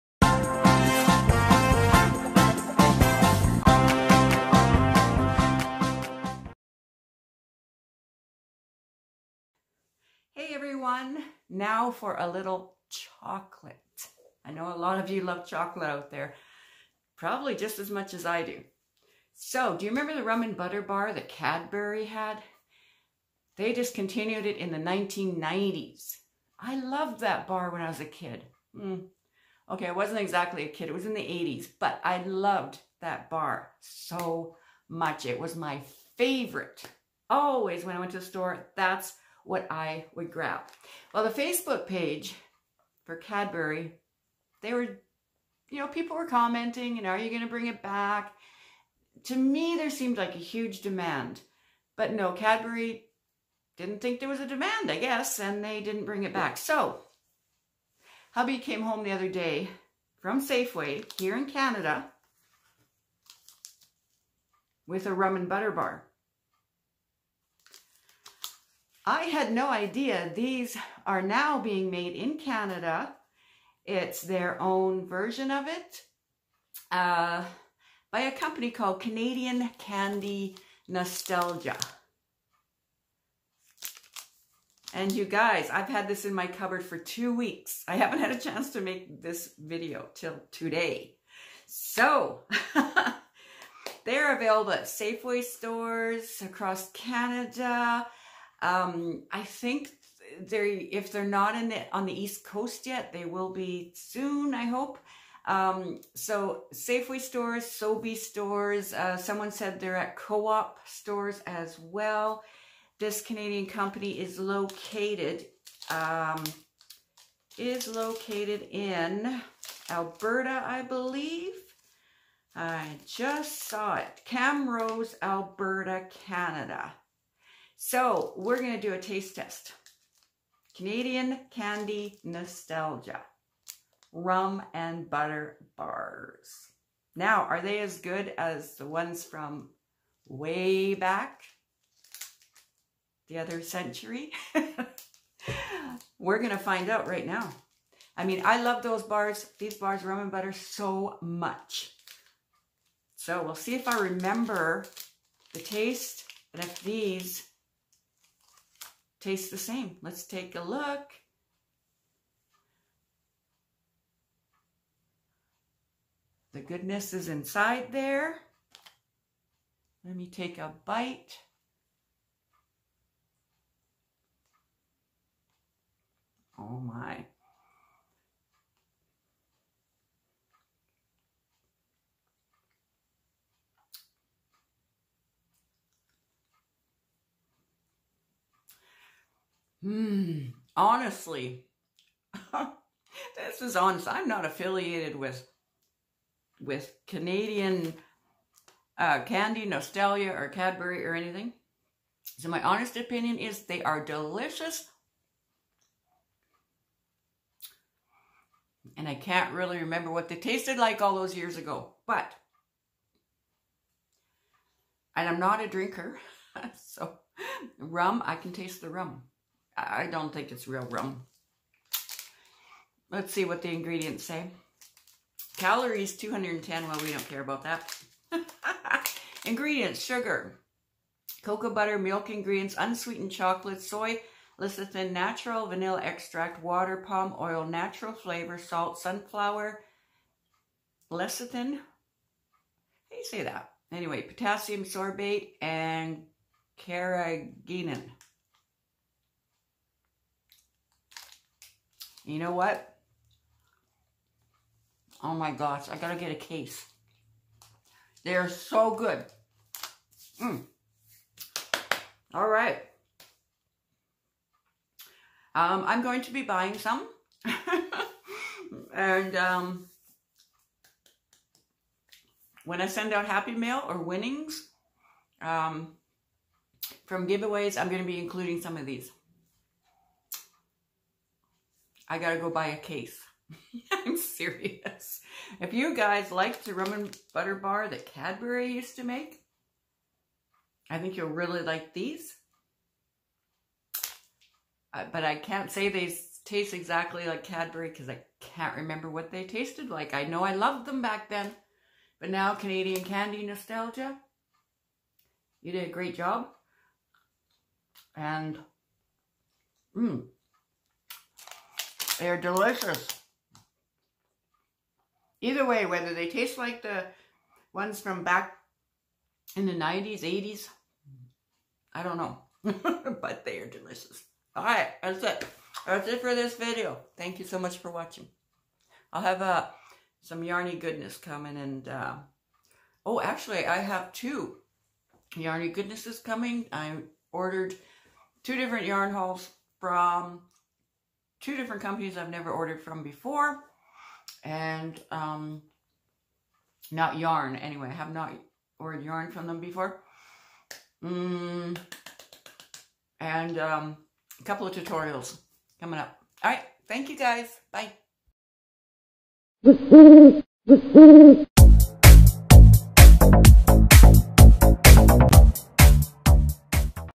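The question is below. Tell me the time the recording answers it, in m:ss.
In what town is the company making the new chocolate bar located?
2:04.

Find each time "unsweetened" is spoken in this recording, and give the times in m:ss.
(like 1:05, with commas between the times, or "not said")
3:52.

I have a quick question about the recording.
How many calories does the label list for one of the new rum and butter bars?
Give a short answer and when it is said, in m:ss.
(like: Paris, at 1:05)
210, at 3:46.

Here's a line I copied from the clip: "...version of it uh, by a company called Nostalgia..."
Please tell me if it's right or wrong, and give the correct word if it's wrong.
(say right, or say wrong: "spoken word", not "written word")
wrong: "Canadian", not "Nostalgia".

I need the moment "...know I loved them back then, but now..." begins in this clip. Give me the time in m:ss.
5:00.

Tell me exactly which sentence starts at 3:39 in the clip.
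I don't think it's real rum.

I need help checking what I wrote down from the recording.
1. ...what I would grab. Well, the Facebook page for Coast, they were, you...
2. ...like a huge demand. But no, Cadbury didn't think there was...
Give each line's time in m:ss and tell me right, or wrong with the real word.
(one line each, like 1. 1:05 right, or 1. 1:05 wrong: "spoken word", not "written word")
1. 0:39 wrong: "Cadbury", not "Coast"
2. 0:50 right.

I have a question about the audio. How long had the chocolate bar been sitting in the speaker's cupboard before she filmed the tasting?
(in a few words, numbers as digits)
2 weeks.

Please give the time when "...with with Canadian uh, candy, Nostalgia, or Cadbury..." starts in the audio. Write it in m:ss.
3:15.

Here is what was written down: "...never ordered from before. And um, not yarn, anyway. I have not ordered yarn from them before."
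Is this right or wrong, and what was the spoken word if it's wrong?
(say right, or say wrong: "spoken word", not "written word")
right.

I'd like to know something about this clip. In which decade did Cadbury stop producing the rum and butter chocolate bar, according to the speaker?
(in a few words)
1990s.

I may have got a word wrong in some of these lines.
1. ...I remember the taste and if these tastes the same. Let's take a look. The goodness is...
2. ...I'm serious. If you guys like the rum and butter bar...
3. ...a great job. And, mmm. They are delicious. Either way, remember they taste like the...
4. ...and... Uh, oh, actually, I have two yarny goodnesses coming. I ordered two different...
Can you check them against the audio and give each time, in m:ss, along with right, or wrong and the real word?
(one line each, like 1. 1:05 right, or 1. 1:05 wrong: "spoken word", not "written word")
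1. 2:33 right
2. 4:44 right
3. 5:05 wrong: "whether", not "remember"
4. 5:31 right.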